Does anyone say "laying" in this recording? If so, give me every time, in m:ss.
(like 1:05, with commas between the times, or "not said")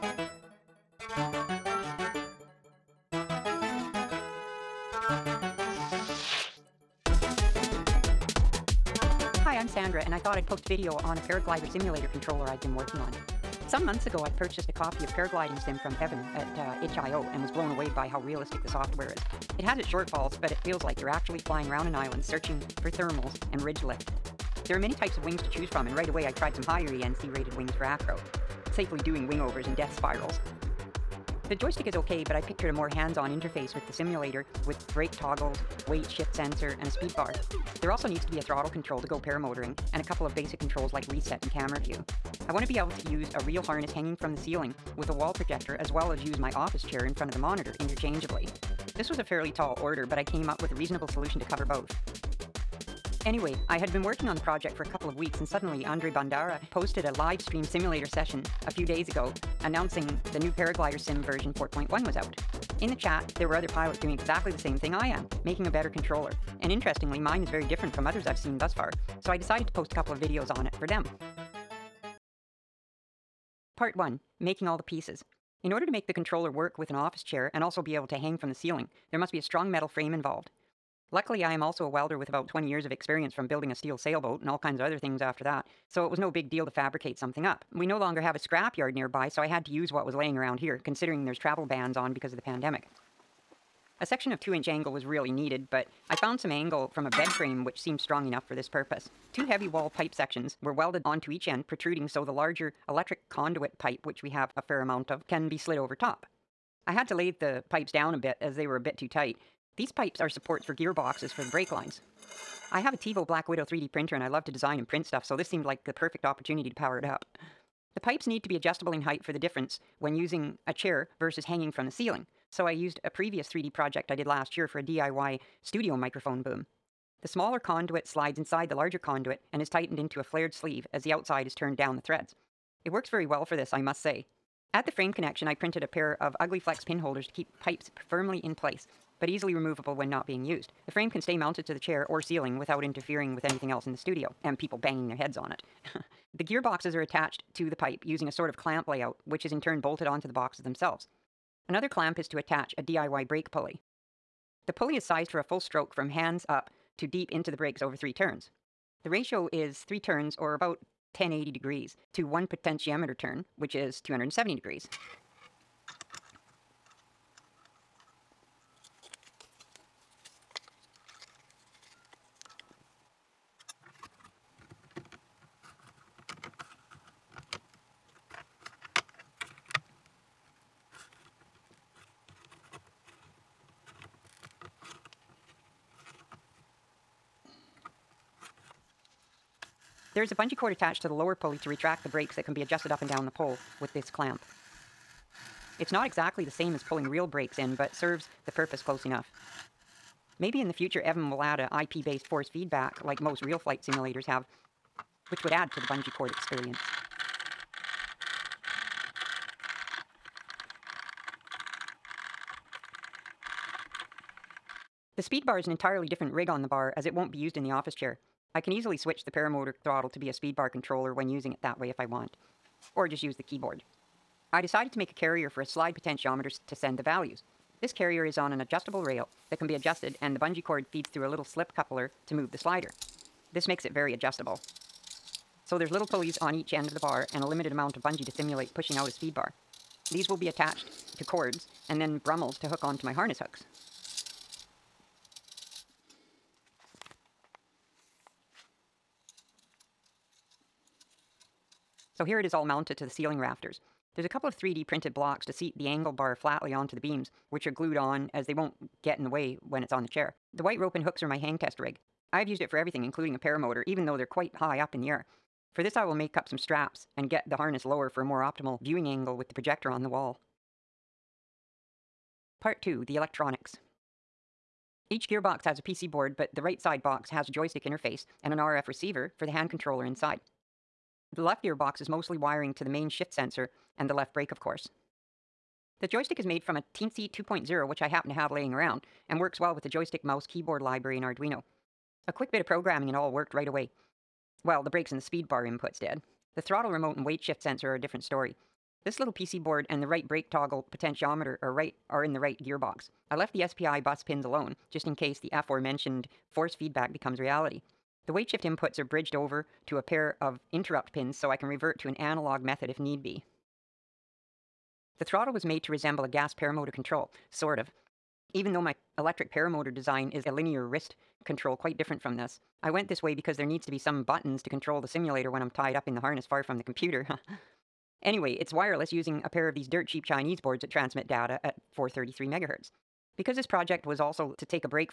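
1:30, 4:48.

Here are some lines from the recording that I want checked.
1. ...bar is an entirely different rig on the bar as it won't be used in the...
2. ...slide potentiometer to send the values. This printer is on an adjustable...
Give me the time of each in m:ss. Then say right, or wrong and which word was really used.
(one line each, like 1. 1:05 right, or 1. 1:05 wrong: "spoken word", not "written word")
1. 3:35 right
2. 3:45 wrong: "carrier", not "printer".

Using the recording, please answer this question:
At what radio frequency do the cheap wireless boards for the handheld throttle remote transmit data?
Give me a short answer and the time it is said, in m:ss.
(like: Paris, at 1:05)
433 megahertz, at 5:31.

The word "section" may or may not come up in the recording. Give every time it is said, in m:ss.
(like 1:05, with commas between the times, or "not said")
1:34, 1:40.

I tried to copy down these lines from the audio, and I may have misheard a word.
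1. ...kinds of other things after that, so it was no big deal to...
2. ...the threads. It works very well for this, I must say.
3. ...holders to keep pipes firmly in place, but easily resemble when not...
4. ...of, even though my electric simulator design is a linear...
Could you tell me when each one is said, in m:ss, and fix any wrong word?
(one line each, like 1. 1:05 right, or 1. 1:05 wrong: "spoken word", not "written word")
1. 1:24 right
2. 2:11 right
3. 2:16 wrong: "removable", not "resemble"
4. 5:17 wrong: "paramotor", not "simulator".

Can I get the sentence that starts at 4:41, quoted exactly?
The left gearbox is mostly wiring to the main shift sensor and the left brake, of course.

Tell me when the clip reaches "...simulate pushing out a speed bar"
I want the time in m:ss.
3:58.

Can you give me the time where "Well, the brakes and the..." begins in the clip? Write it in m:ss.
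4:54.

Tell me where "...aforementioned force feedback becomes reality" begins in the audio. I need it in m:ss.
5:05.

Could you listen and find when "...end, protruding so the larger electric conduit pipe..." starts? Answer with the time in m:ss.
1:41.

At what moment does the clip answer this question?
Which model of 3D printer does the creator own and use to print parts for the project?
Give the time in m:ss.
1:52.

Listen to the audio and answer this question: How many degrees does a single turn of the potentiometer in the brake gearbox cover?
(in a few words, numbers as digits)
270 degrees.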